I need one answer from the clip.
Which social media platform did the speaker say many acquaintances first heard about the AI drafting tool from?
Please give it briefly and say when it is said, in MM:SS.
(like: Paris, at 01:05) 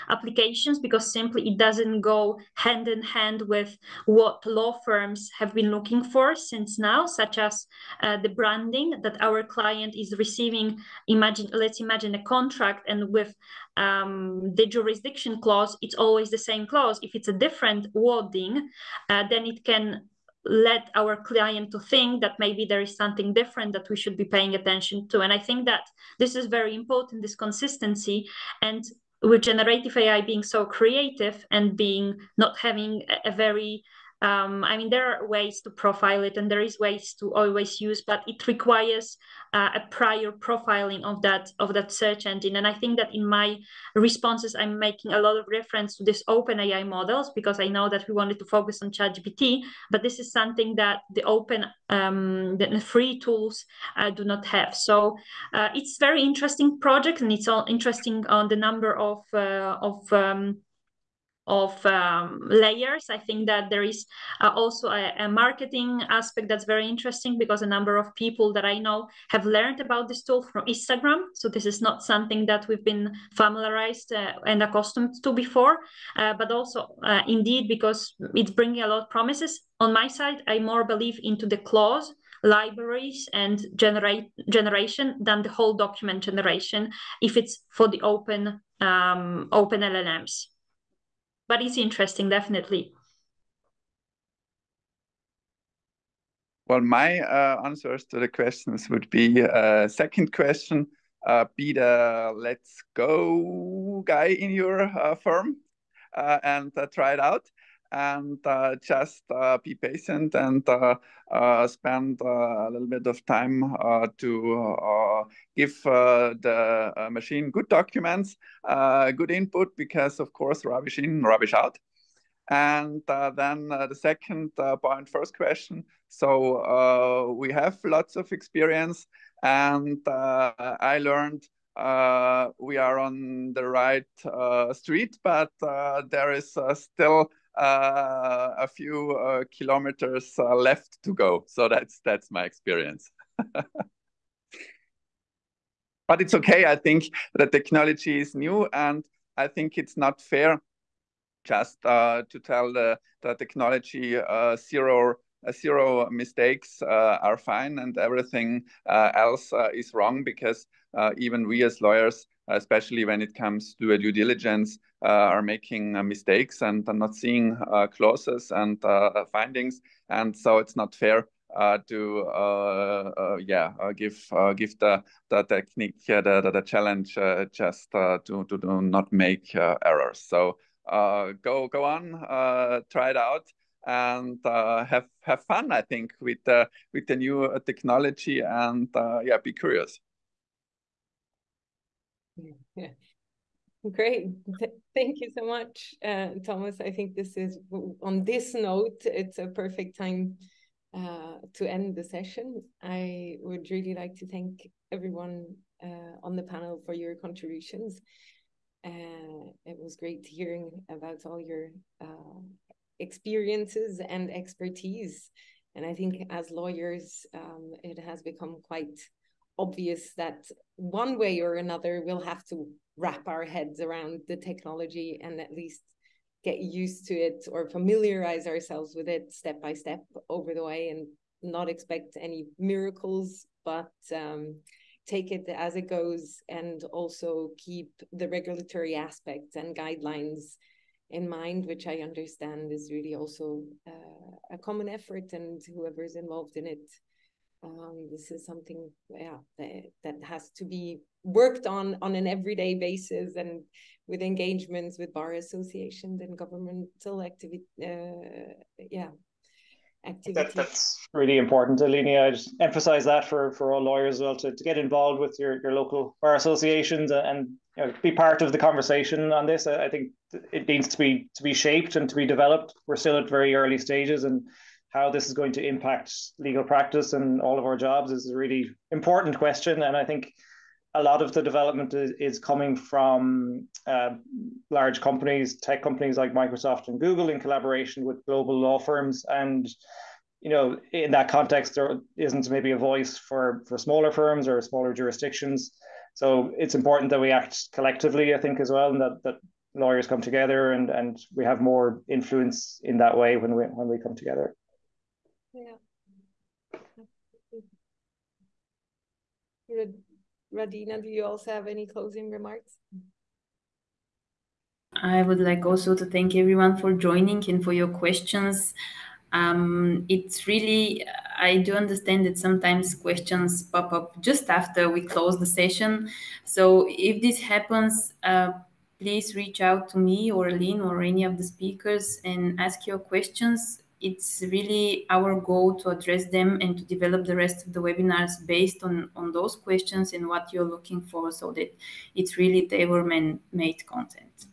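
Instagram, at 01:10.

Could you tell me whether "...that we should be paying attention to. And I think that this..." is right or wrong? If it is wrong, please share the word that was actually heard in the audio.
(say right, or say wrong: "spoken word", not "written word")
right.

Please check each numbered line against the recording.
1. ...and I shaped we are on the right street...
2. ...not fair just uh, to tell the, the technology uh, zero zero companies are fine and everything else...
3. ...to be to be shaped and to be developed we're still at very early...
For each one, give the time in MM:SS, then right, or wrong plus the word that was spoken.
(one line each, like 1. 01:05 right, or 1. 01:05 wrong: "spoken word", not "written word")
1. 02:09 wrong: "learned", not "shaped"
2. 02:29 wrong: "mistakes", not "companies"
3. 04:30 right.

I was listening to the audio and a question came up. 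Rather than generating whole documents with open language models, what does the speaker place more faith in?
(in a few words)
Clause libraries.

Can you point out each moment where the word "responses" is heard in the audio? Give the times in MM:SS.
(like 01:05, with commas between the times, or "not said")
00:43.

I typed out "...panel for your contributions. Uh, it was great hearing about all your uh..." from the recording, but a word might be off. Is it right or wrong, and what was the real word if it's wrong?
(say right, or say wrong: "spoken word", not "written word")
right.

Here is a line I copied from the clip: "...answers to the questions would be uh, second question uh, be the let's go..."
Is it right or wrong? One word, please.
right.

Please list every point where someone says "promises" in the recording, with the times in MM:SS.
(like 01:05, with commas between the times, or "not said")
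01:19.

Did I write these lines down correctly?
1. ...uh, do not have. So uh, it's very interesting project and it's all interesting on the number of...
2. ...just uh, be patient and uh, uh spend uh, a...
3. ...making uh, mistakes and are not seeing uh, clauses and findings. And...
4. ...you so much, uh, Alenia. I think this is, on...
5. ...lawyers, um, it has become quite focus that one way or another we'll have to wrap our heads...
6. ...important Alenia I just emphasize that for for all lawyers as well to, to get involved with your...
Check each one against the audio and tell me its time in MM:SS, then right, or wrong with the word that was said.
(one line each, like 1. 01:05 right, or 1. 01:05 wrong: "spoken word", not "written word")
1. 00:53 right
2. 01:48 right
3. 02:45 right
4. 03:15 wrong: "Thomas", not "Alenia"
5. 03:36 wrong: "obvious", not "focus"
6. 04:21 right.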